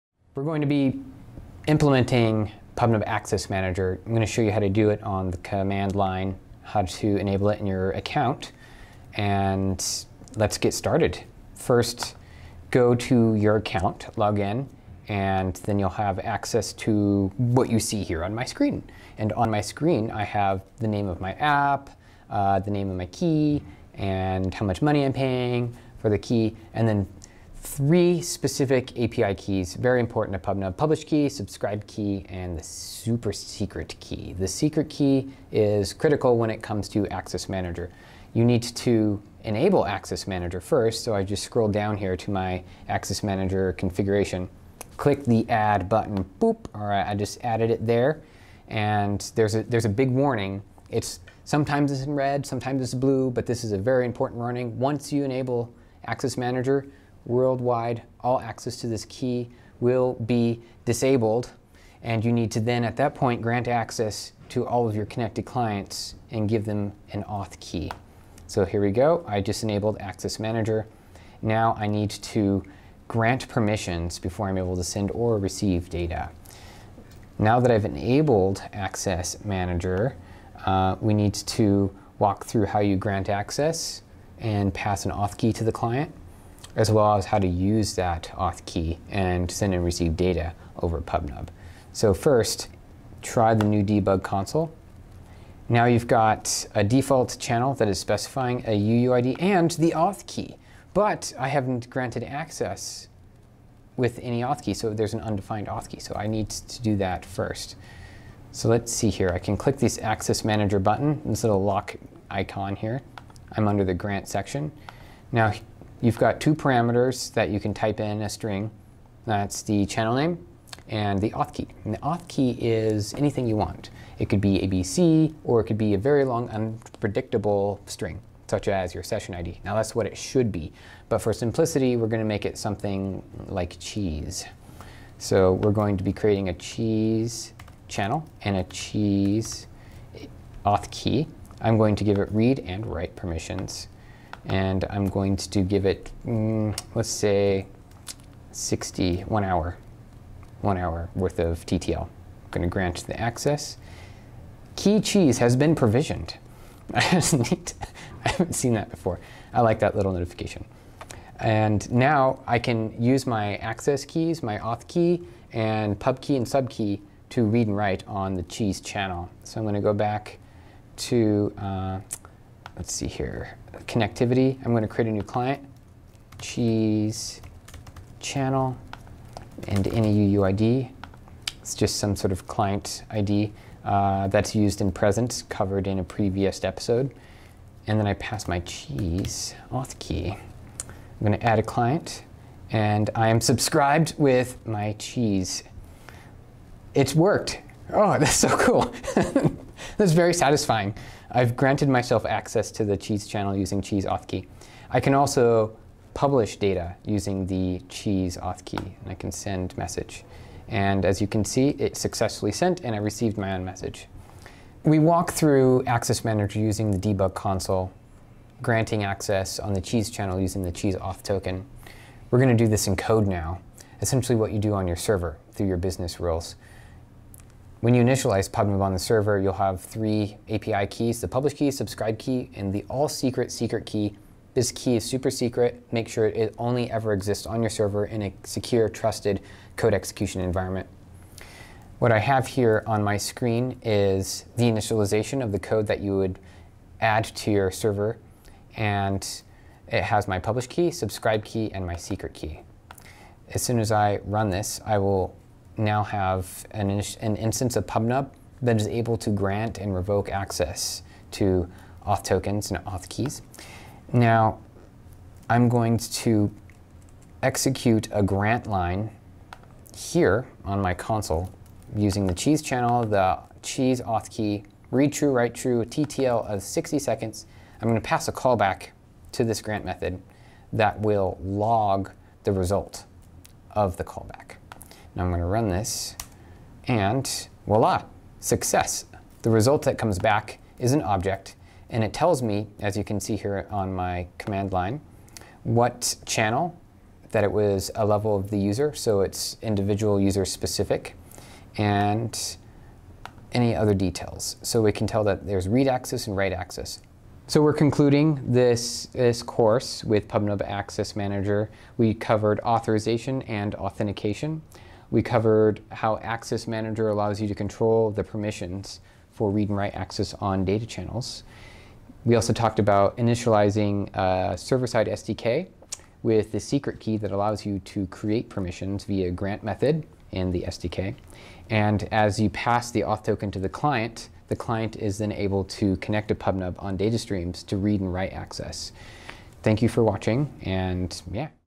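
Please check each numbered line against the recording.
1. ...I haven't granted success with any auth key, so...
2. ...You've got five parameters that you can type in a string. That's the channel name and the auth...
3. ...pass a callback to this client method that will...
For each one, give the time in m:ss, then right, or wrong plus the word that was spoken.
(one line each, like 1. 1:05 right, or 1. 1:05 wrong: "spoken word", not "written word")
1. 1:41 wrong: "access", not "success"
2. 1:56 wrong: "two", not "five"
3. 4:38 wrong: "grant", not "client".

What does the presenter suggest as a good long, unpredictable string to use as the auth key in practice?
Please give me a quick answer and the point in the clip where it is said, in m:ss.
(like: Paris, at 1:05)
session ID, at 2:08.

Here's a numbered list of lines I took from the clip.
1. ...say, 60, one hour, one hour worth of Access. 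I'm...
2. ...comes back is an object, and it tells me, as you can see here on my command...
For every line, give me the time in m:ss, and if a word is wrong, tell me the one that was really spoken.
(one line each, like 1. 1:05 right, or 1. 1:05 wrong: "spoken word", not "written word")
1. 2:27 wrong: "TTL", not "Access"
2. 4:49 right.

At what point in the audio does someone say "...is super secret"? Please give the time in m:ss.
3:54.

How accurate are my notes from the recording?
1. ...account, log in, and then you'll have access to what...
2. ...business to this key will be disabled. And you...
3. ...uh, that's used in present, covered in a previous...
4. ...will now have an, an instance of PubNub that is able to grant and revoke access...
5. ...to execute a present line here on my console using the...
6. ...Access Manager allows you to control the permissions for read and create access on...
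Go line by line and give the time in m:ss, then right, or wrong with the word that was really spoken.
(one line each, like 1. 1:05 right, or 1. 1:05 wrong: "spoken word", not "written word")
1. 0:13 right
2. 0:58 wrong: "access", not "business"
3. 3:03 right
4. 4:14 right
5. 4:25 wrong: "grant", not "present"
6. 5:16 wrong: "write", not "create".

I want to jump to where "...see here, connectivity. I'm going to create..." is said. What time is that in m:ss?
2:52.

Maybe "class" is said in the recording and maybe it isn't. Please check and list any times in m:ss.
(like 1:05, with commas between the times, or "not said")
not said.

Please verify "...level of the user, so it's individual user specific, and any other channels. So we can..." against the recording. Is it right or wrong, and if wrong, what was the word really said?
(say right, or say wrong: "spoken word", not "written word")
wrong: "details", not "channels".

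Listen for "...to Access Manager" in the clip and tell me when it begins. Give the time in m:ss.
0:36.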